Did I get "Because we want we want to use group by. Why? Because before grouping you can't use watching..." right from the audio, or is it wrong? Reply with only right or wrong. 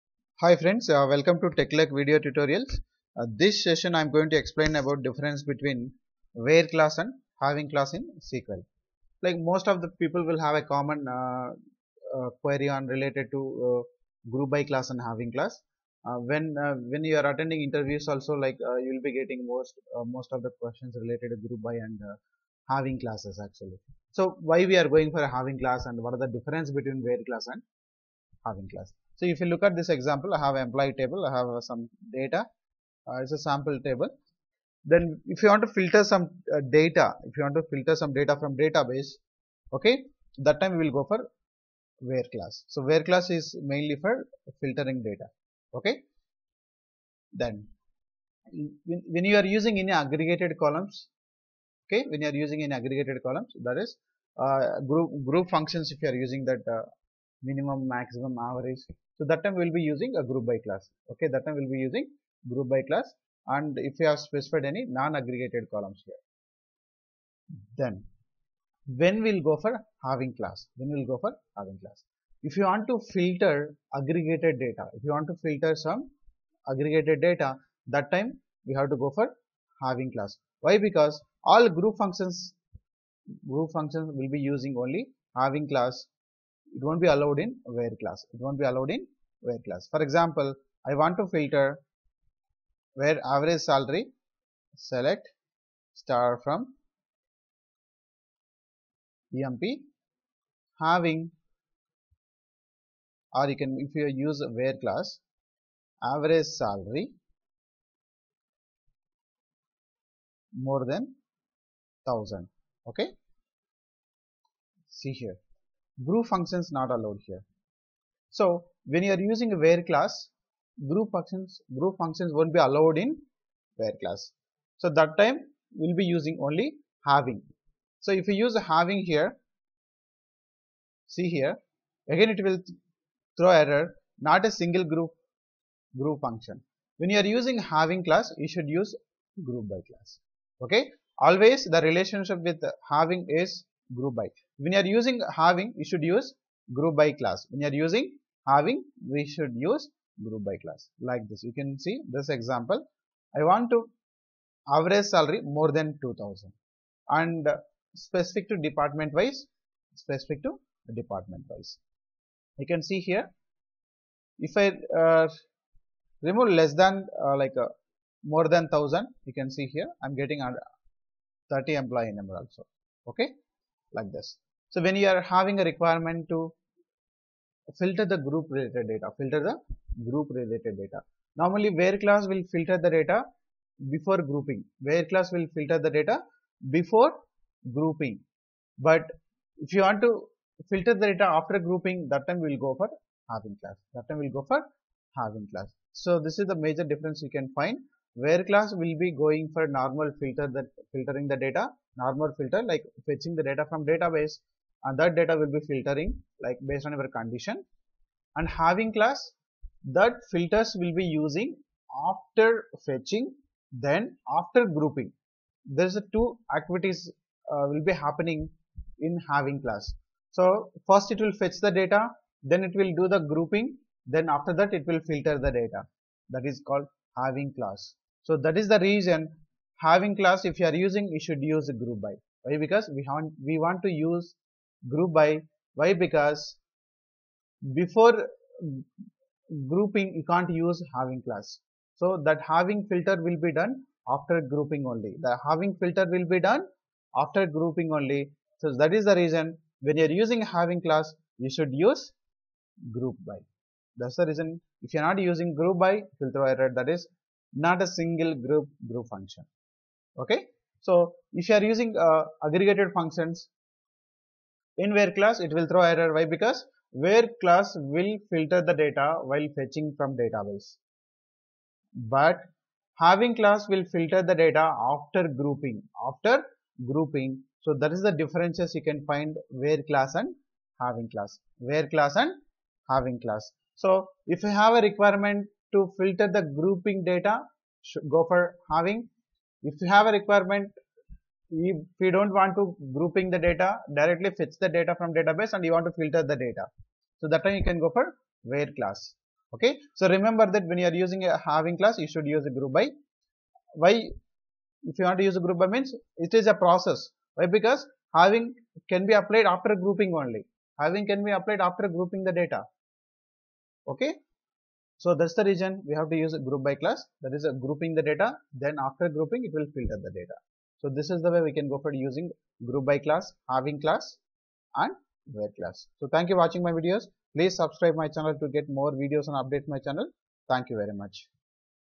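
wrong.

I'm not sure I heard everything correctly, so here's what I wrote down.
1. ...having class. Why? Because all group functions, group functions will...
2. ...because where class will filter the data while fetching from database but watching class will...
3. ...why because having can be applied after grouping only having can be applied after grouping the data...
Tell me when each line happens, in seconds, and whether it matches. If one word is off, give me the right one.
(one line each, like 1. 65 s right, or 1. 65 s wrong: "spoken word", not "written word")
1. 79 s right
2. 266 s wrong: "having", not "watching"
3. 307 s right.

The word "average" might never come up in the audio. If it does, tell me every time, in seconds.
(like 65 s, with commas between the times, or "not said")
58 s, 93 s, 106 s, 154 s.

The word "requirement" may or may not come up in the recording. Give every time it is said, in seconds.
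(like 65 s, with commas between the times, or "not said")
175 s, 284 s, 290 s.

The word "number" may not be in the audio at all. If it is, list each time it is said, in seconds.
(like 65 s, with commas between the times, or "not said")
172 s.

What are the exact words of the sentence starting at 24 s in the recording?
So why we are going for a having class and what are the difference between where class and having class.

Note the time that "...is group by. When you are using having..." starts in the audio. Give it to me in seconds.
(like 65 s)
143 s.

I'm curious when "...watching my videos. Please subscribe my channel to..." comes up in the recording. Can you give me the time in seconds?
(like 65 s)
326 s.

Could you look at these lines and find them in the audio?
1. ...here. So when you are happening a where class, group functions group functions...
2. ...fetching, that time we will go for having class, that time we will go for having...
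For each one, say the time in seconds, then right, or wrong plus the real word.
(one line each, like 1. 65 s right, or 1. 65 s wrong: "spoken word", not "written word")
1. 117 s wrong: "using", not "happening"
2. 191 s wrong: "grouping", not "fetching".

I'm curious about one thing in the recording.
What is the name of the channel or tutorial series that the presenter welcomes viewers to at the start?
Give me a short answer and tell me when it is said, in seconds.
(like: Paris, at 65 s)
TechLake, at 1 s.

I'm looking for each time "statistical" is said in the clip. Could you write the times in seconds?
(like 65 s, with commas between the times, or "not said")
not said.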